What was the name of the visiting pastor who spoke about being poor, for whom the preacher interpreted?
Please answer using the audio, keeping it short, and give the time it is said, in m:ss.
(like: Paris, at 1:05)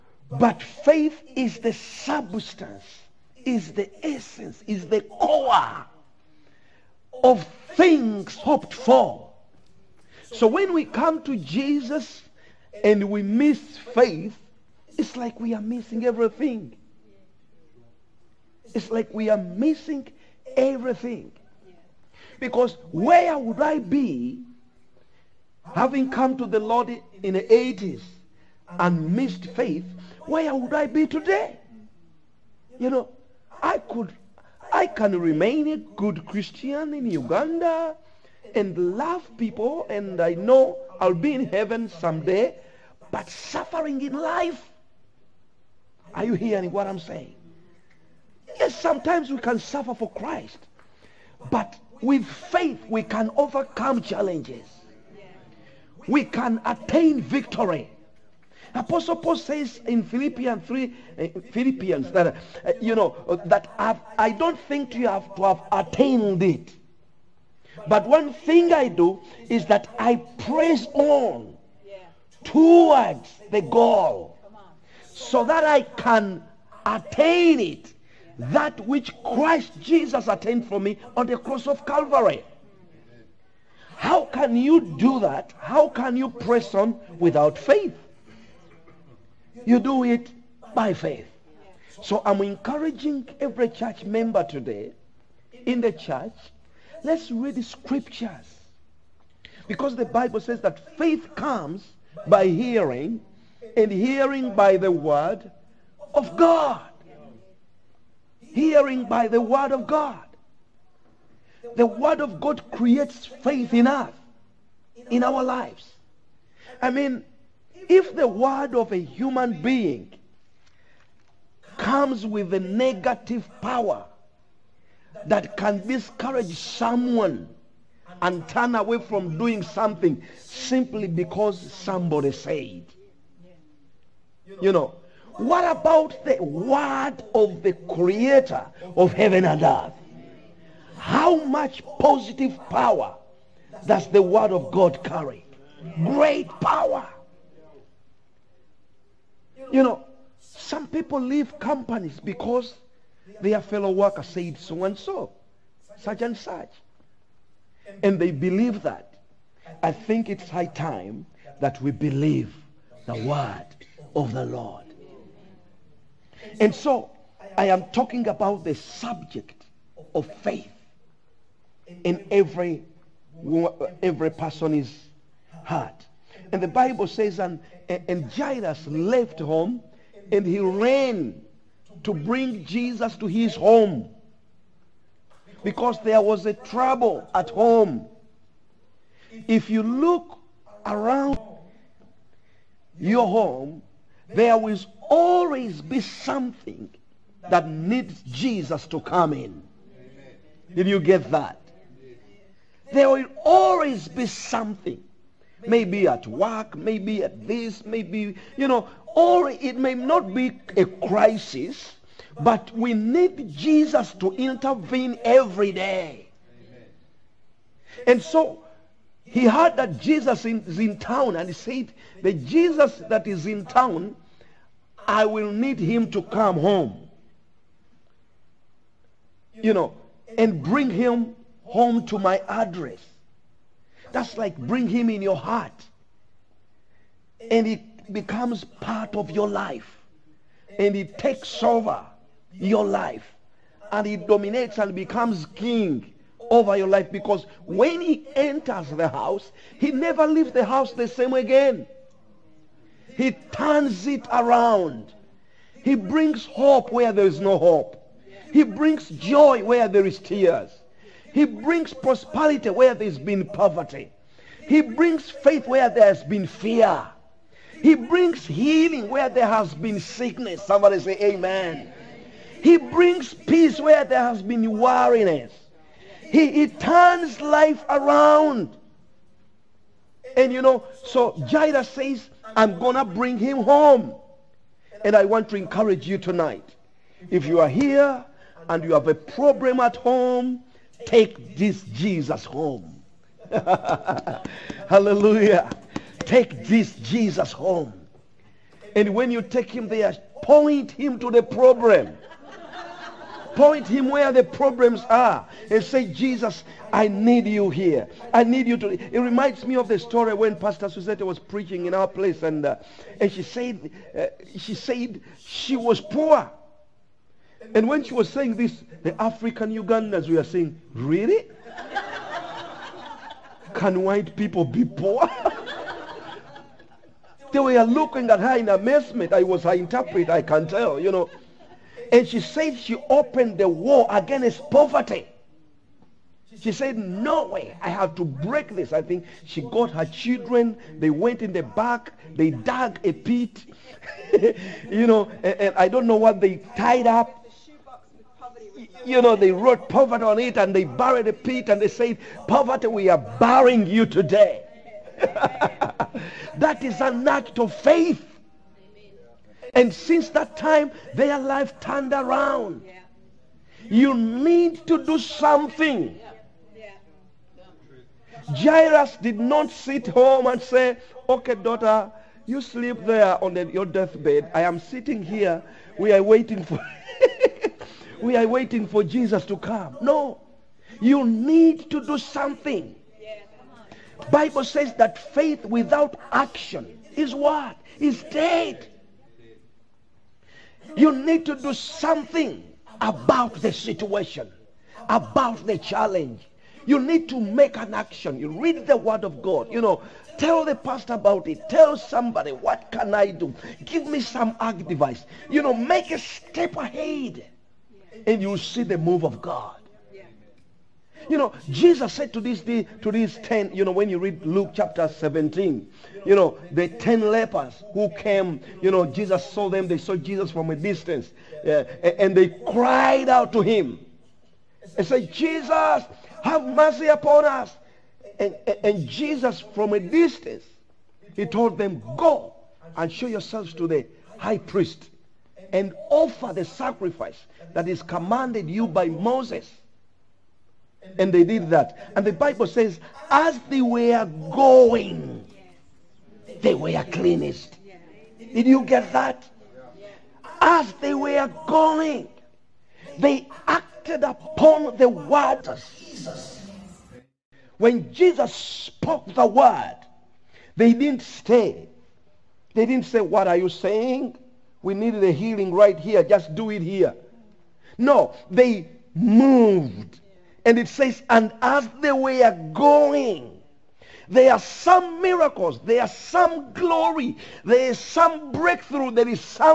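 Pastor Suzette, at 5:10.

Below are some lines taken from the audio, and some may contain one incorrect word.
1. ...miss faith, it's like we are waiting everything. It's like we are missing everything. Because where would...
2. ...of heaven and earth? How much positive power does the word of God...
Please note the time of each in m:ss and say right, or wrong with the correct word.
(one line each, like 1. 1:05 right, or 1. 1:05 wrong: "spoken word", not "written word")
1. 0:13 wrong: "missing", not "waiting"
2. 2:18 right.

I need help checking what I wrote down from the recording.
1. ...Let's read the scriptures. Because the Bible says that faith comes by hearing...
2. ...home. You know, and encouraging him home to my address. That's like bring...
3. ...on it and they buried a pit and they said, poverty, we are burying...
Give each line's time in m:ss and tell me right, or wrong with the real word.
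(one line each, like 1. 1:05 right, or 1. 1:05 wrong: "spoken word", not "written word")
1. 1:37 right
2. 3:46 wrong: "bring", not "encouraging"
3. 5:50 right.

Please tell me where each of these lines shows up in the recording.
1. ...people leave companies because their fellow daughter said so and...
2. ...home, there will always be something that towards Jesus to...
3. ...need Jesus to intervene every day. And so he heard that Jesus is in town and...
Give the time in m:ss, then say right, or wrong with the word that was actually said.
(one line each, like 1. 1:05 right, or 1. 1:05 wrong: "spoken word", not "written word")
1. 2:30 wrong: "worker", not "daughter"
2. 3:13 wrong: "needs", not "towards"
3. 3:32 right.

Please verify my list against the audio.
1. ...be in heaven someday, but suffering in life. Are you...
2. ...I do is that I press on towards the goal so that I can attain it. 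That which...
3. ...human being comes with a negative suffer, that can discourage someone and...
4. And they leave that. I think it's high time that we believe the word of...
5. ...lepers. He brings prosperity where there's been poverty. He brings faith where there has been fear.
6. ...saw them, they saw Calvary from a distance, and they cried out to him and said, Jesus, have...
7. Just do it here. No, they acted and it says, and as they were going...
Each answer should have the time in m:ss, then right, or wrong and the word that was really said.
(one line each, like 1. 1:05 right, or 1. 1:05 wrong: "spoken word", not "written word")
1. 0:41 right
2. 1:08 right
3. 1:58 wrong: "power", not "suffer"
4. 2:38 wrong: "believe", not "leave"
5. 4:20 wrong: "tears", not "lepers"
6. 6:59 wrong: "Jesus", not "Calvary"
7. 7:46 wrong: "moved", not "acted".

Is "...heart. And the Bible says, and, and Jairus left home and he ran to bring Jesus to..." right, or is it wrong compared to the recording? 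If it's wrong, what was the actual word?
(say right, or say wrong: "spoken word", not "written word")
right.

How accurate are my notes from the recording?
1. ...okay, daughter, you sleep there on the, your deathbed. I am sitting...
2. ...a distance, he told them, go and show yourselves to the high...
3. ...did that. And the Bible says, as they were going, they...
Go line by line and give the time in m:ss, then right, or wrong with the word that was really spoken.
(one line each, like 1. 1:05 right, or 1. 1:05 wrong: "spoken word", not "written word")
1. 6:11 right
2. 7:09 right
3. 7:21 right.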